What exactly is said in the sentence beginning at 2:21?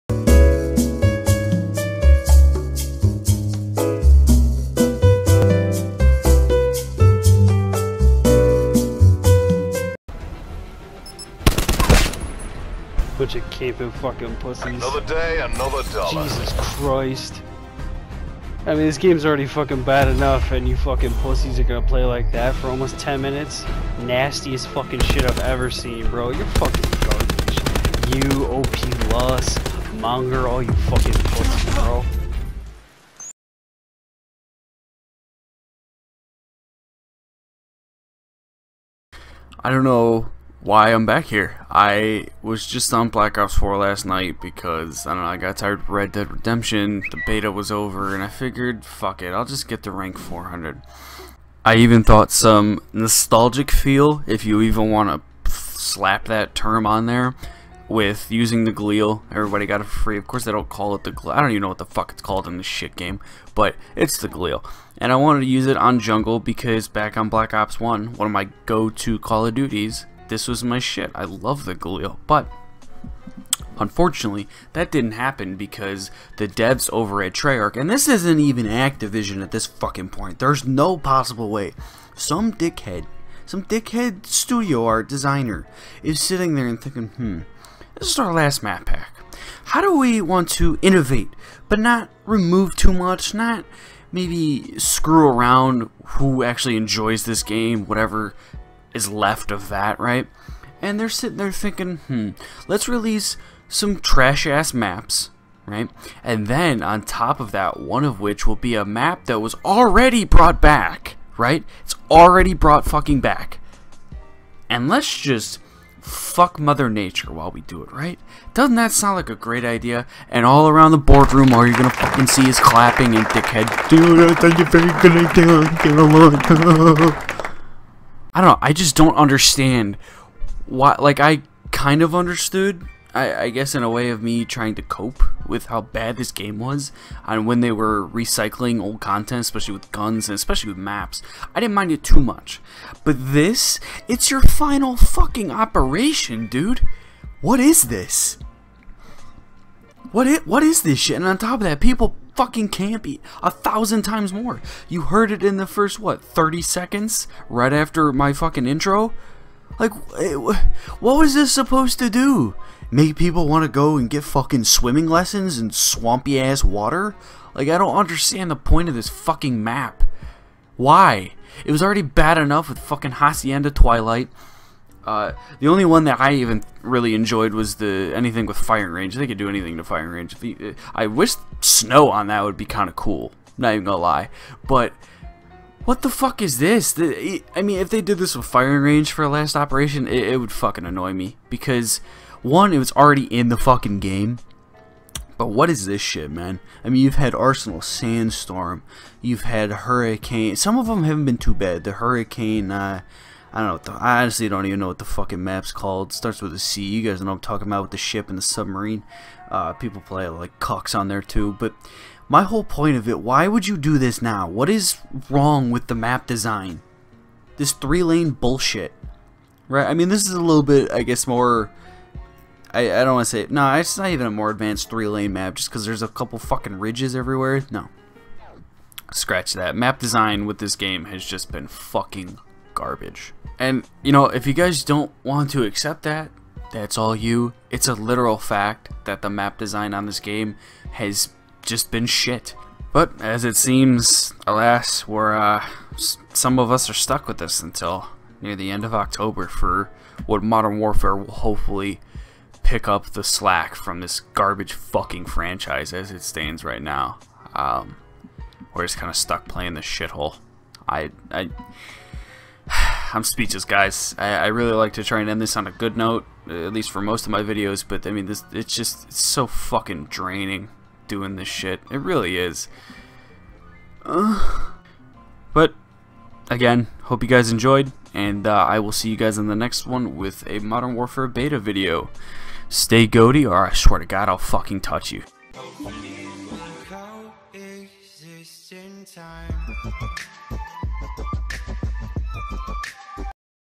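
I didn't mind it too much.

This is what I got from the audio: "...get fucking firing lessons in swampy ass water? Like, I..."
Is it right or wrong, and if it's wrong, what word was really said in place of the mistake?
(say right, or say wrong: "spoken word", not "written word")
wrong: "swimming", not "firing".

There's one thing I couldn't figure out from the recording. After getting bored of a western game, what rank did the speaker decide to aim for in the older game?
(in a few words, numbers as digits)
400.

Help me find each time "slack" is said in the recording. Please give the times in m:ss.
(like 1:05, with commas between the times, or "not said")
4:13.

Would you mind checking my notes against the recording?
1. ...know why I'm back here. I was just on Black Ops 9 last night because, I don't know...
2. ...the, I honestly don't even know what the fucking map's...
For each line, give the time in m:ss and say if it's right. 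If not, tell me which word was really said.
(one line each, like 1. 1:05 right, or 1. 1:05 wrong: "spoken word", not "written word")
1. 0:39 wrong: "4", not "9"
2. 3:23 right.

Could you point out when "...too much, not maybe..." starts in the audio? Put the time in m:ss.
1:32.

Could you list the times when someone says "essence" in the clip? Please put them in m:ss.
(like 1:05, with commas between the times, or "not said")
not said.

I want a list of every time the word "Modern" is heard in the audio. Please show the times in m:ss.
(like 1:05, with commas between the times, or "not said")
4:10, 4:40.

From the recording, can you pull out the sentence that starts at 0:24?
Nastiest fucking shit I've ever seen, bro.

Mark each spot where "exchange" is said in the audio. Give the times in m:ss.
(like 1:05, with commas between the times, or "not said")
not said.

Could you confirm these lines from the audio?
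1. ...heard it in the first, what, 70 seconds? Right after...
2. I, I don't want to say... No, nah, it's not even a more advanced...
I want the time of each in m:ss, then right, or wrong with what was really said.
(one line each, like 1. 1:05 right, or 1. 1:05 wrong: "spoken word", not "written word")
1. 2:35 wrong: "30", not "70"
2. 3:42 right.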